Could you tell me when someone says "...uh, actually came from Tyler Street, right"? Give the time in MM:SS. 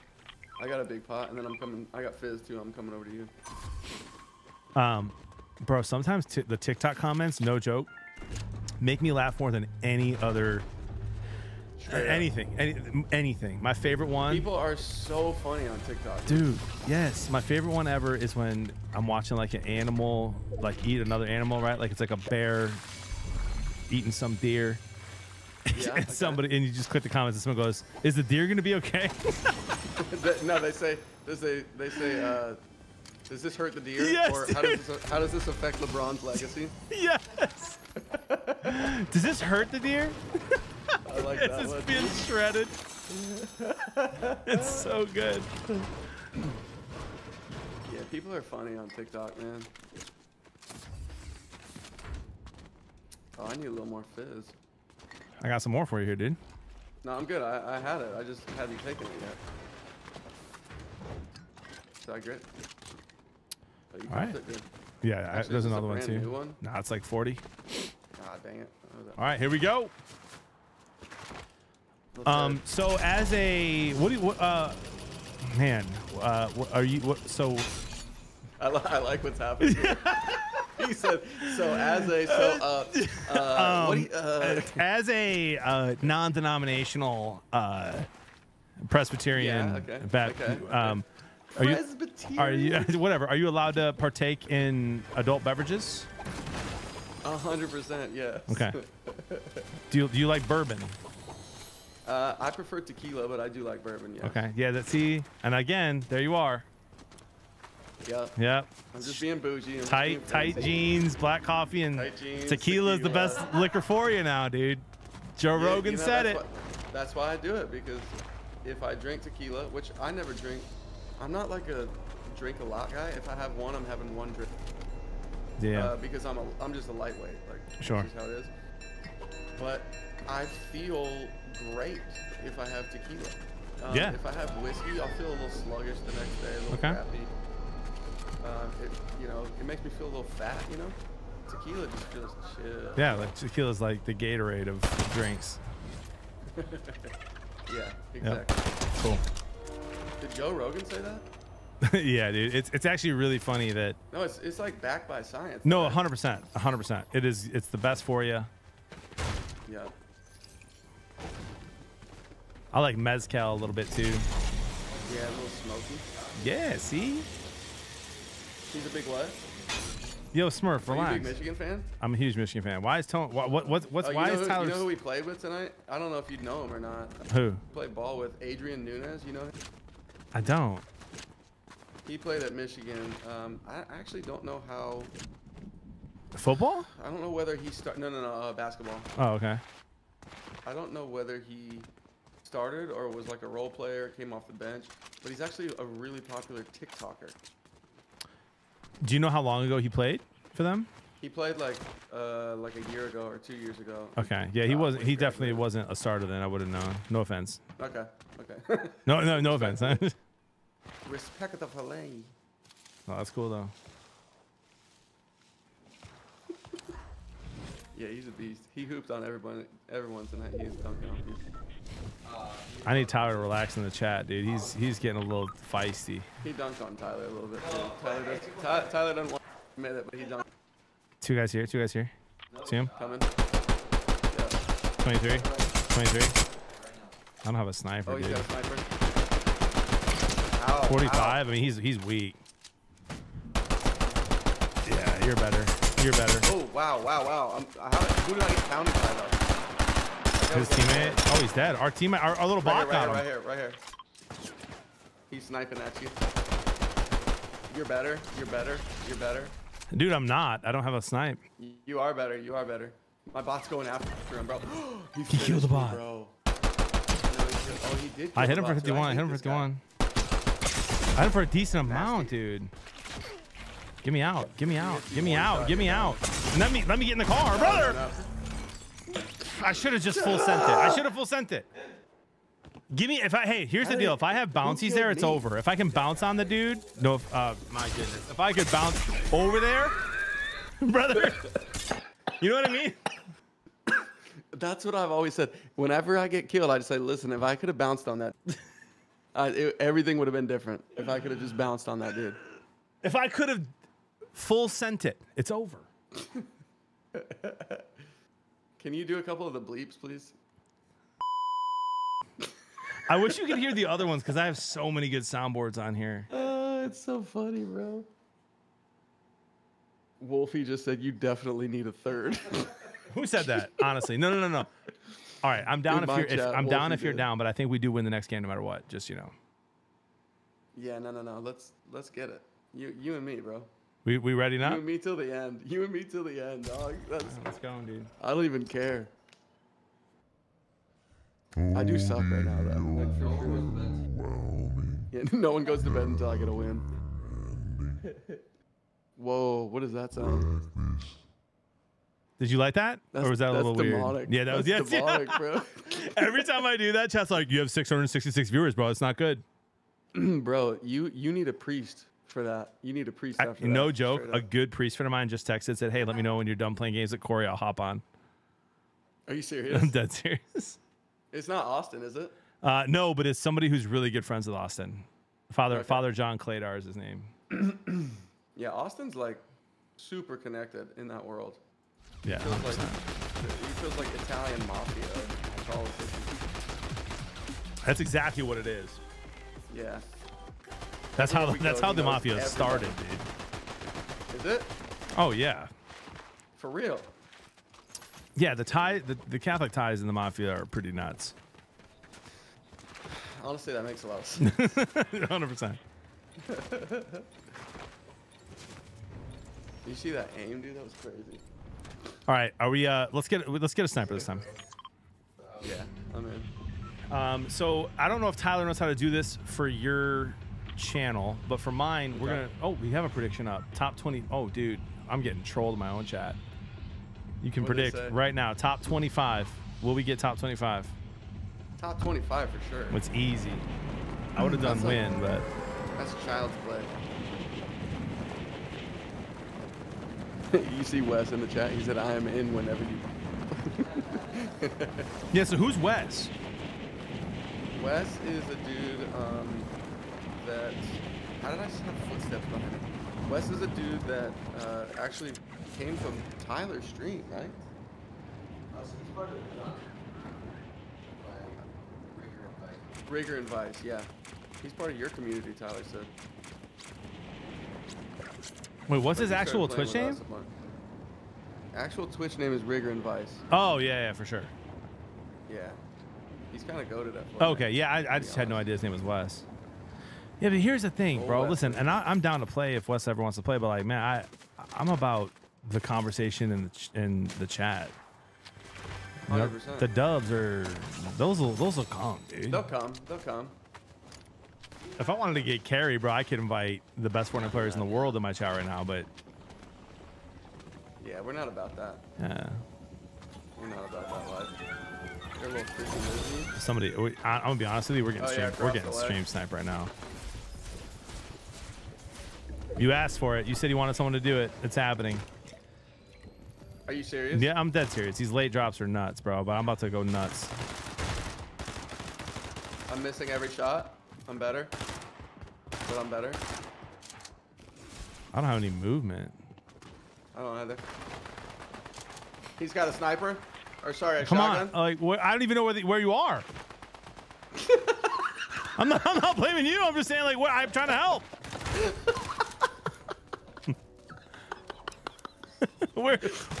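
07:34.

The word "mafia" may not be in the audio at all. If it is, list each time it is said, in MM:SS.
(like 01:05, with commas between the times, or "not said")
06:24, 06:32, 06:40.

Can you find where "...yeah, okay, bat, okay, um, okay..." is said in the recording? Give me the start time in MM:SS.
01:29.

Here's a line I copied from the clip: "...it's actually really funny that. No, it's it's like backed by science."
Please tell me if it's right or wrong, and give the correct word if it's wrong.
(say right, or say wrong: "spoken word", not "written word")
right.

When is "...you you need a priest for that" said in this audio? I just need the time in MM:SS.
06:00.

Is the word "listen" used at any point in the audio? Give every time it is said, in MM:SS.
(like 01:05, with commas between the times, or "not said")
04:56, 08:01.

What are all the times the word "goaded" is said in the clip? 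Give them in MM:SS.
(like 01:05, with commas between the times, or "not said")
07:56.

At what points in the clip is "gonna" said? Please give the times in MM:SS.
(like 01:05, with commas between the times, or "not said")
00:28, 07:02, 08:27.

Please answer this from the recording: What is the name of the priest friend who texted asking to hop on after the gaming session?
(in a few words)
Father John Claydar.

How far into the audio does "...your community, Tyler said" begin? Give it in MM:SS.
07:44.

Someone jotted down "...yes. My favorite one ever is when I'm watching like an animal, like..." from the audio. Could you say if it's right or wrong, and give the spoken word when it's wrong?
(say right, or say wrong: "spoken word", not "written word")
right.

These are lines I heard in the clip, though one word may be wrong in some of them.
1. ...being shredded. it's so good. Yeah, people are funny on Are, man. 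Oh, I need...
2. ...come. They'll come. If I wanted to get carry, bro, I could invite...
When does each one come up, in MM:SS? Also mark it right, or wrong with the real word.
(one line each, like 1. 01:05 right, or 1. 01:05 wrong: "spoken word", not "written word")
1. 00:41 wrong: "TikTok", not "Are"
2. 08:12 right.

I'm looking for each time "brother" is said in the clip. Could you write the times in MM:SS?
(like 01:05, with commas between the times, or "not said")
04:37, 04:50.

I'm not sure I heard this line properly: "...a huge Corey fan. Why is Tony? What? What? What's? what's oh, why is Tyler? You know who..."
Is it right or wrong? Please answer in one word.
wrong.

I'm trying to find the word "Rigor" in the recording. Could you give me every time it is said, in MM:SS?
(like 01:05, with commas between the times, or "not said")
07:43.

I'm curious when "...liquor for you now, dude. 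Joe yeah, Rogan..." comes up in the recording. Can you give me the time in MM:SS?
01:53.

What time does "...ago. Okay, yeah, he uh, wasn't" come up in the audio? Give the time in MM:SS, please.
03:23.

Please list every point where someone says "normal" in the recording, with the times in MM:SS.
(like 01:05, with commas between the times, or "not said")
not said.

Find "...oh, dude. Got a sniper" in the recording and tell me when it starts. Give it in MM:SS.
03:58.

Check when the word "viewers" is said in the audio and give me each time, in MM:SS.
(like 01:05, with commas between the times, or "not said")
05:58.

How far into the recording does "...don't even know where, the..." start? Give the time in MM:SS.
08:55.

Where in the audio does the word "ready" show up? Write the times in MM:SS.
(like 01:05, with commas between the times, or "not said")
05:34.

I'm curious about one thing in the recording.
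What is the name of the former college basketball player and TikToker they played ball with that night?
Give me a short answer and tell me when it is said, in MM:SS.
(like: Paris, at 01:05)
Adrien Nunez, at 02:58.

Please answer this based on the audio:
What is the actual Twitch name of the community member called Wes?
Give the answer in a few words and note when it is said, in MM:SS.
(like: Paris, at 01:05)
Rigger and Vice, at 07:52.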